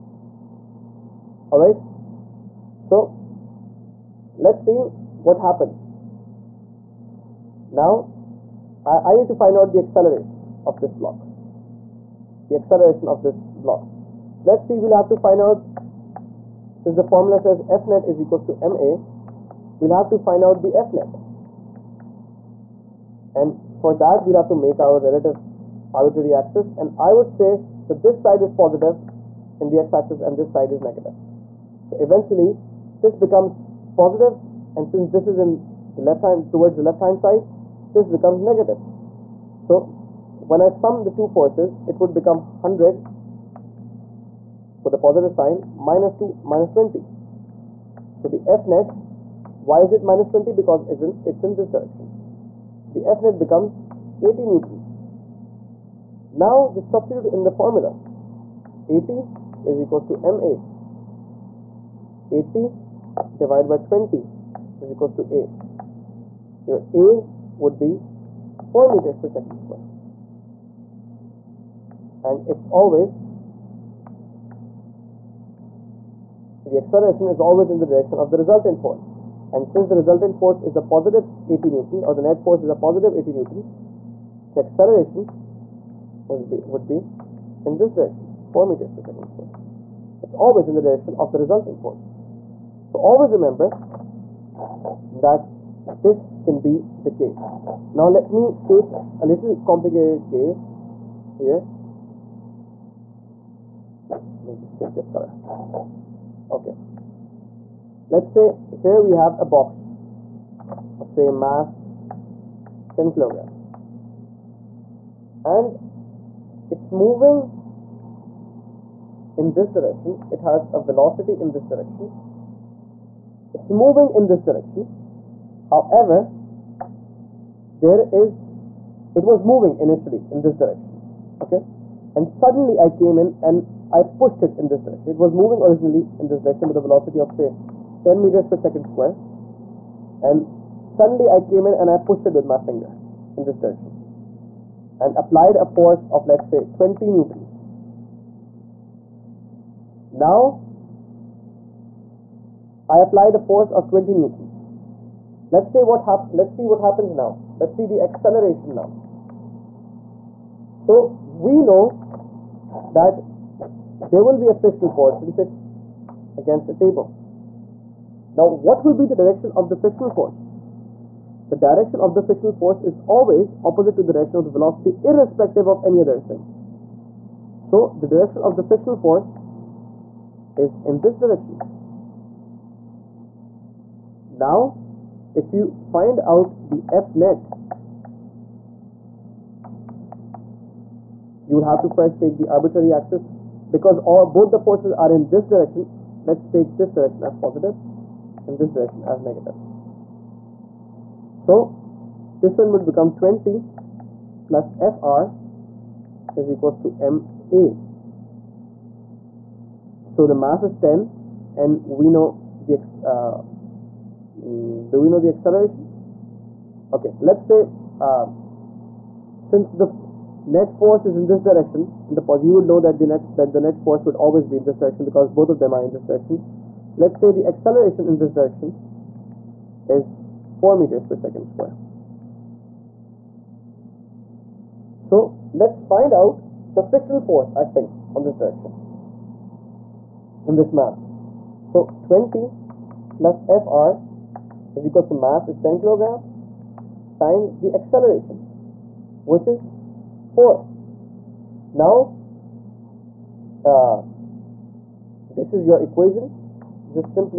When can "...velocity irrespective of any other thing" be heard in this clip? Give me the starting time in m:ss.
2:54.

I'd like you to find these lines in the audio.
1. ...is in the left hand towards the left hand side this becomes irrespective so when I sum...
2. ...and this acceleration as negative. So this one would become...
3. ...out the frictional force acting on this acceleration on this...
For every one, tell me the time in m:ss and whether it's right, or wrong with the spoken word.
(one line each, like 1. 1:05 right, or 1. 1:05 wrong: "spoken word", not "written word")
1. 0:35 wrong: "negative", not "irrespective"
2. 3:18 wrong: "direction", not "acceleration"
3. 3:56 wrong: "direction", not "acceleration".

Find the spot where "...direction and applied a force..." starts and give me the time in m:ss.
2:23.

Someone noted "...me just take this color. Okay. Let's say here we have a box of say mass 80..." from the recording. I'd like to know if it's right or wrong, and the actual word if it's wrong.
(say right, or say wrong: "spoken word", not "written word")
wrong: "10", not "80".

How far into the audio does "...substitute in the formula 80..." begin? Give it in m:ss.
0:56.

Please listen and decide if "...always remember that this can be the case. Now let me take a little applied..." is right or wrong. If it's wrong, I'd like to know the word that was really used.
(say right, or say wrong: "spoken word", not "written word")
wrong: "complicated", not "applied".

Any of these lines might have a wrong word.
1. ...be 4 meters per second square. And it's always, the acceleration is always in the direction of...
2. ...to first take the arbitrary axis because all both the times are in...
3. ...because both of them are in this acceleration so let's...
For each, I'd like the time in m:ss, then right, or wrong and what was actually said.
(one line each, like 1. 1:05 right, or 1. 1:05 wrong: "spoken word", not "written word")
1. 1:07 right
2. 3:11 wrong: "forces", not "times"
3. 3:45 wrong: "direction", not "acceleration".